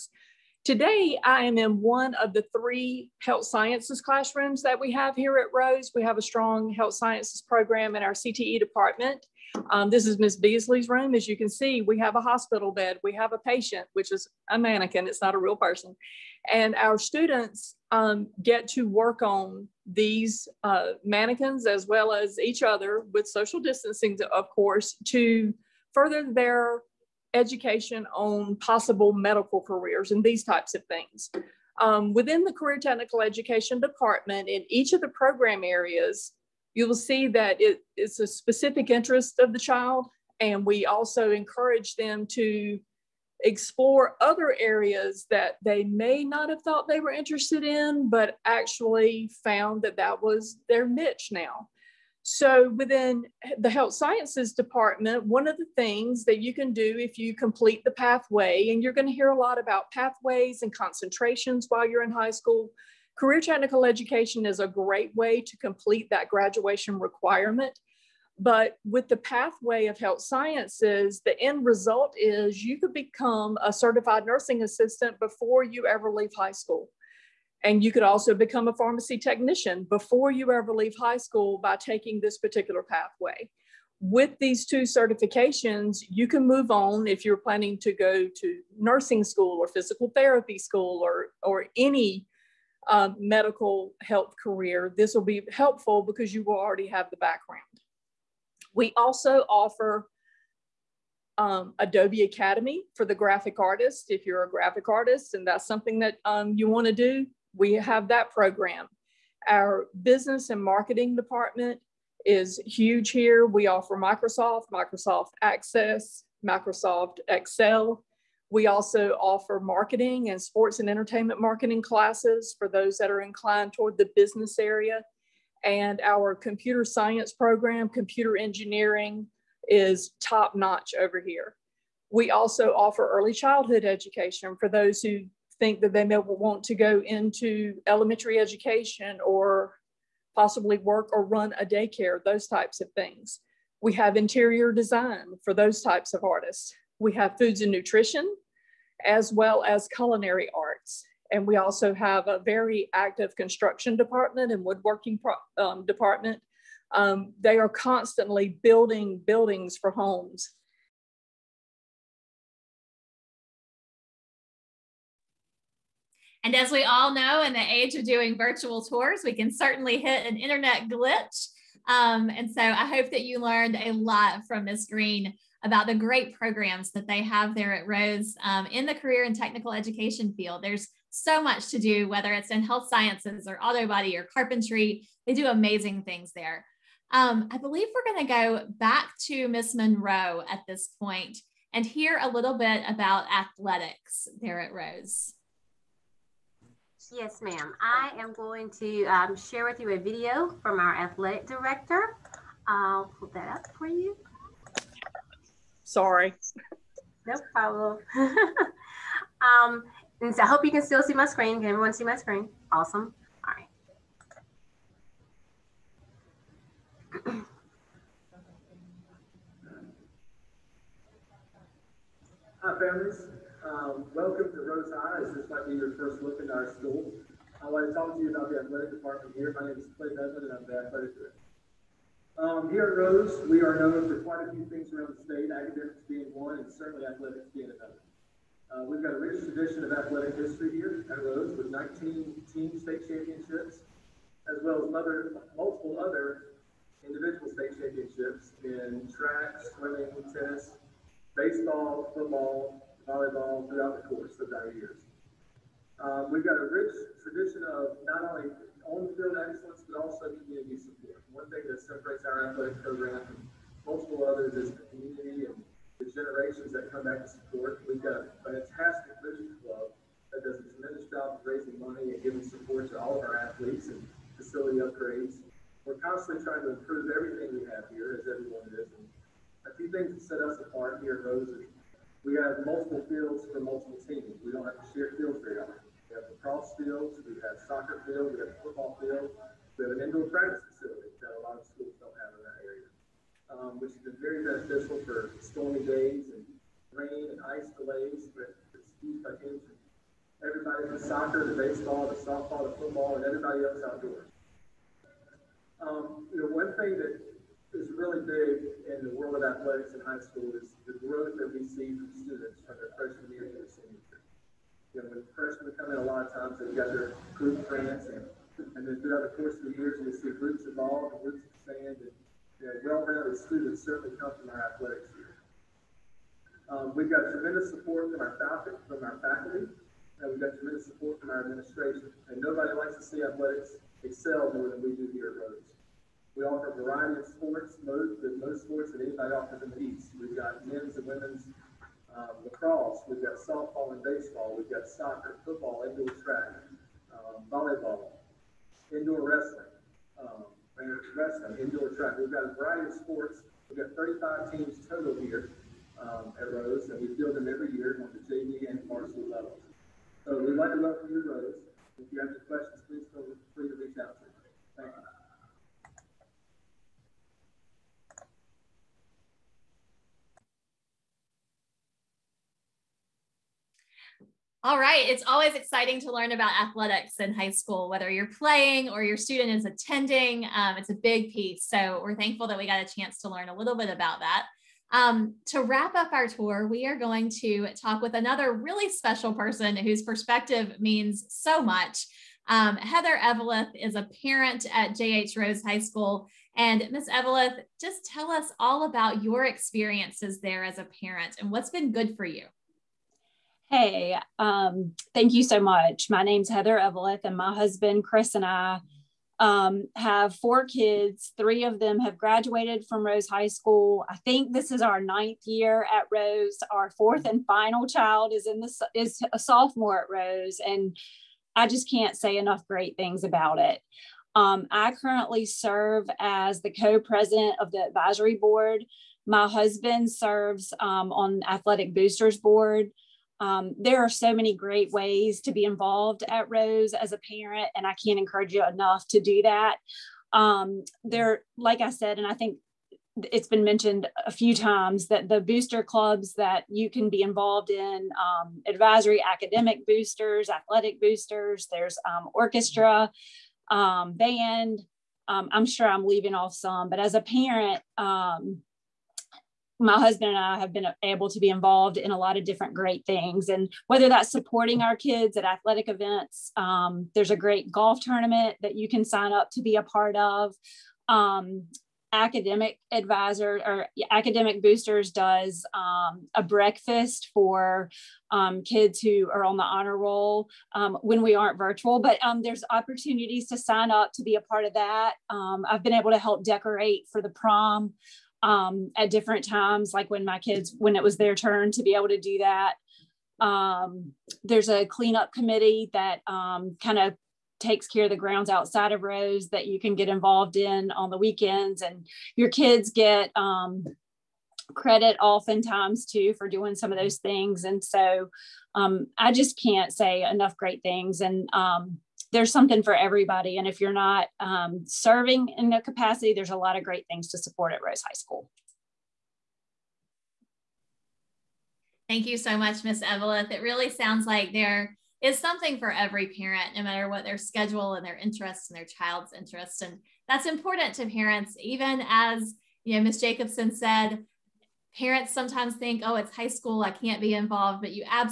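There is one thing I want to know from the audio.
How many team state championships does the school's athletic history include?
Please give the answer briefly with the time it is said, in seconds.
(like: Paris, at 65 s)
19, at 241 s.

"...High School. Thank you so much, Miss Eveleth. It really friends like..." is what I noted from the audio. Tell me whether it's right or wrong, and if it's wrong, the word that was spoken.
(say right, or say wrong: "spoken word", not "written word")
wrong: "sounds", not "friends".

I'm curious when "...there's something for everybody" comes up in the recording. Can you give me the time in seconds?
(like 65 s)
512 s.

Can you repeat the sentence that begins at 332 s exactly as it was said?
And nobody likes to see athletics excel more than we do here at Rose.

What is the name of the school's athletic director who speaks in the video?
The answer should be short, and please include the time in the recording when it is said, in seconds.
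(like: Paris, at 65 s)
Clay Bevan, at 229 s.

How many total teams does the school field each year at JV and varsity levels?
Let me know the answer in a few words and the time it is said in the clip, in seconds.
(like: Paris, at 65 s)
35, at 353 s.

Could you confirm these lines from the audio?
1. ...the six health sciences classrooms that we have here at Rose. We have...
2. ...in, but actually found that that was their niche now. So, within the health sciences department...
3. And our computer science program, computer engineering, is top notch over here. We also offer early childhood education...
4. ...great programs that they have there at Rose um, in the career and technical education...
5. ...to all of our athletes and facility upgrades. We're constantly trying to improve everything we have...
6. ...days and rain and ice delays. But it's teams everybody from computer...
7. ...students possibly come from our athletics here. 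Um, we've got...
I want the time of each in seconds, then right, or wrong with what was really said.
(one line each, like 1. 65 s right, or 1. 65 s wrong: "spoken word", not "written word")
1. 2 s wrong: "three", not "six"
2. 47 s right
3. 125 s right
4. 175 s right
5. 272 s right
6. 295 s wrong: "soccer", not "computer"
7. 323 s wrong: "certainly", not "possibly".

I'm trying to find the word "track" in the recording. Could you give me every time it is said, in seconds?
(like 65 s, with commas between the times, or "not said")
249 s, 346 s, 351 s.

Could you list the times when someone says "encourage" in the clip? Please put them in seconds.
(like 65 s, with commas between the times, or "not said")
41 s, 438 s.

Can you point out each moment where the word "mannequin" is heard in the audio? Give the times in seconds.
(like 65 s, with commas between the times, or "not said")
14 s, 21 s.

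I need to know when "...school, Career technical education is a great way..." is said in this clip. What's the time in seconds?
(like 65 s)
62 s.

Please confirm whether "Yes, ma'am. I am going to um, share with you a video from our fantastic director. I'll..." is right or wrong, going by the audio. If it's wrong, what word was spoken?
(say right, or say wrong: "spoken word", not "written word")
wrong: "athletic", not "fantastic".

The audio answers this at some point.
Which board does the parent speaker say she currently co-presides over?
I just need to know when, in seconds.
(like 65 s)
427 s.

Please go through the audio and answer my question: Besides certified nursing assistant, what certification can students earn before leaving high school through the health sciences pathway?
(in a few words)
Pharmacy technician.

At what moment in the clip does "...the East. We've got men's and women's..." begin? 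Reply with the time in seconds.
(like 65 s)
339 s.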